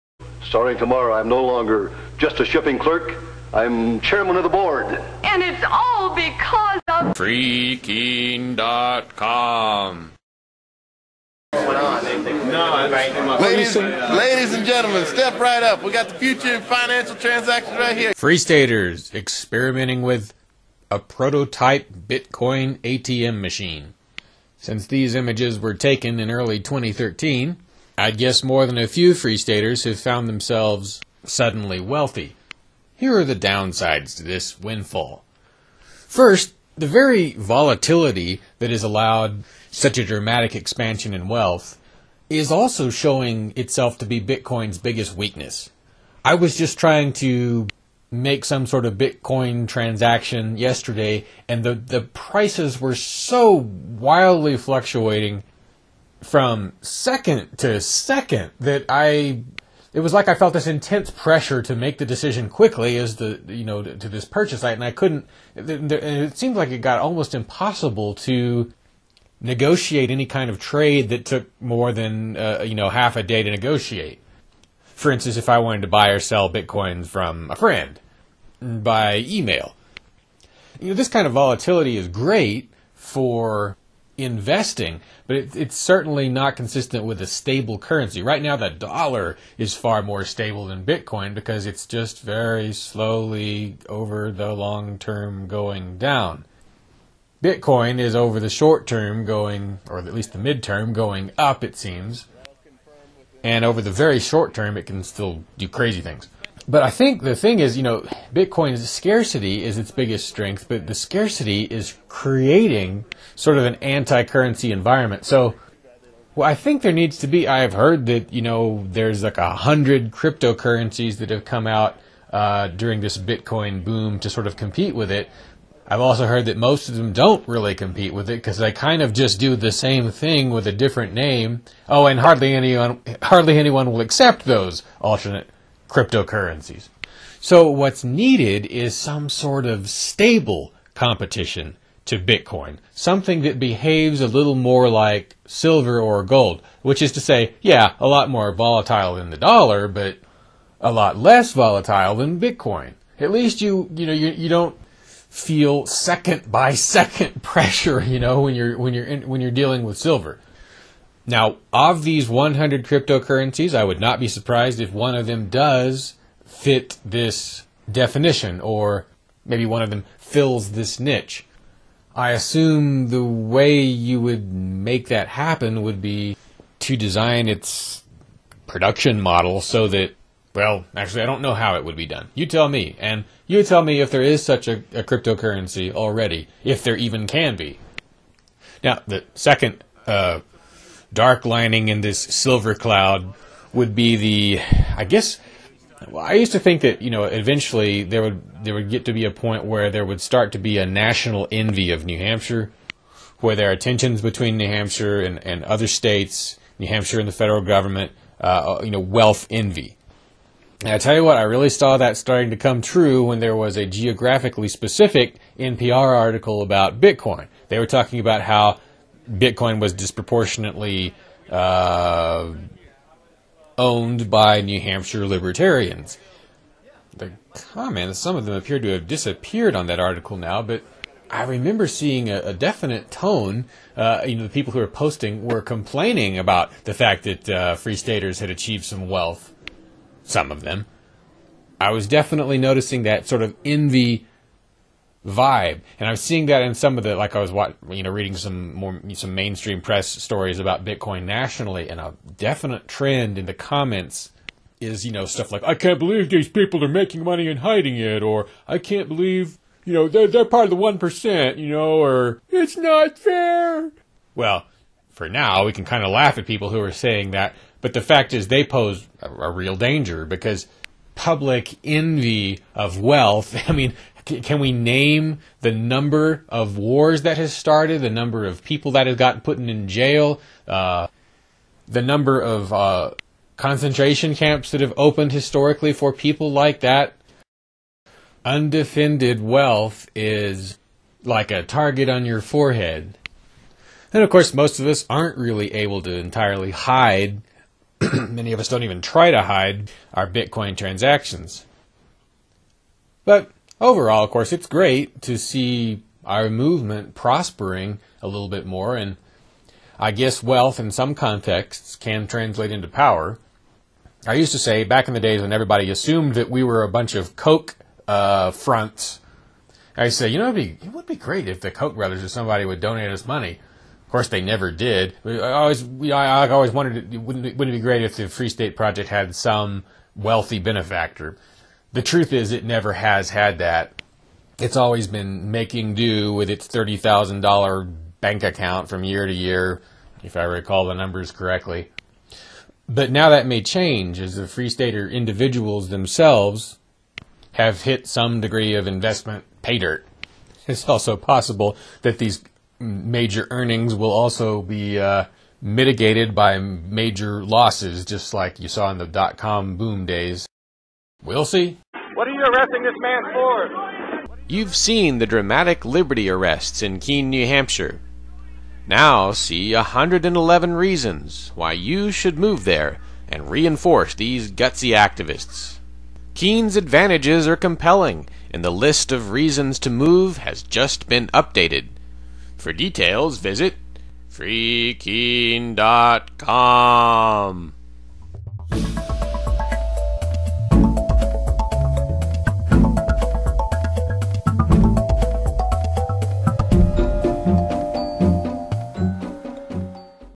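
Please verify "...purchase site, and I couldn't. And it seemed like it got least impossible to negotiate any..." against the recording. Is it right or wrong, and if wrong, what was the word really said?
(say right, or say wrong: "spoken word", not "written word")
wrong: "almost", not "least".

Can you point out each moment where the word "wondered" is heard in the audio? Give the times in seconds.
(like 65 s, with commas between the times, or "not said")
326 s.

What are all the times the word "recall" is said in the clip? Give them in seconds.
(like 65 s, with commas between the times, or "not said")
340 s.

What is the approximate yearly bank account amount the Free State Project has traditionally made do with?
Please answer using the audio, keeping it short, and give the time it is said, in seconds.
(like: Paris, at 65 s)
$30,000, at 336 s.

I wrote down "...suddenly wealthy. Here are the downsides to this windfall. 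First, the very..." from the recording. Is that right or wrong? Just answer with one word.
right.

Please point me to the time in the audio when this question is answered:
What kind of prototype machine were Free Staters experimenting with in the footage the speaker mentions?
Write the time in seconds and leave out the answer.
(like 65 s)
21 s.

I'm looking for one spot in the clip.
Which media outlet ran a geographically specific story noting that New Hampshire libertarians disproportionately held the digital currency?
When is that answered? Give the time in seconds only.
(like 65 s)
215 s.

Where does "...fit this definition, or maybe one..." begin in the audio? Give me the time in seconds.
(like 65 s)
166 s.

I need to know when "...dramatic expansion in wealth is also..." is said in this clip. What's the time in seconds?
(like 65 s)
40 s.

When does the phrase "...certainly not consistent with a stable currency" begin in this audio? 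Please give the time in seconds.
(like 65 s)
85 s.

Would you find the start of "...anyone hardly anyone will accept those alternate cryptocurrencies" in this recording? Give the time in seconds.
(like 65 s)
132 s.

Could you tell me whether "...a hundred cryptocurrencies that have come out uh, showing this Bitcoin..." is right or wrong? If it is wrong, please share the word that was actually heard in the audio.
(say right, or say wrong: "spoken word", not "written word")
wrong: "during", not "showing".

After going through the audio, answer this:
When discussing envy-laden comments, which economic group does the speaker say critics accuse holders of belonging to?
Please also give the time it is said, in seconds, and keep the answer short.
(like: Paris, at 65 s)
the one percent, at 260 s.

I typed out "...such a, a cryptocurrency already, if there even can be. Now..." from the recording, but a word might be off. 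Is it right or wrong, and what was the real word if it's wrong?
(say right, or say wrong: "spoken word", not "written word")
right.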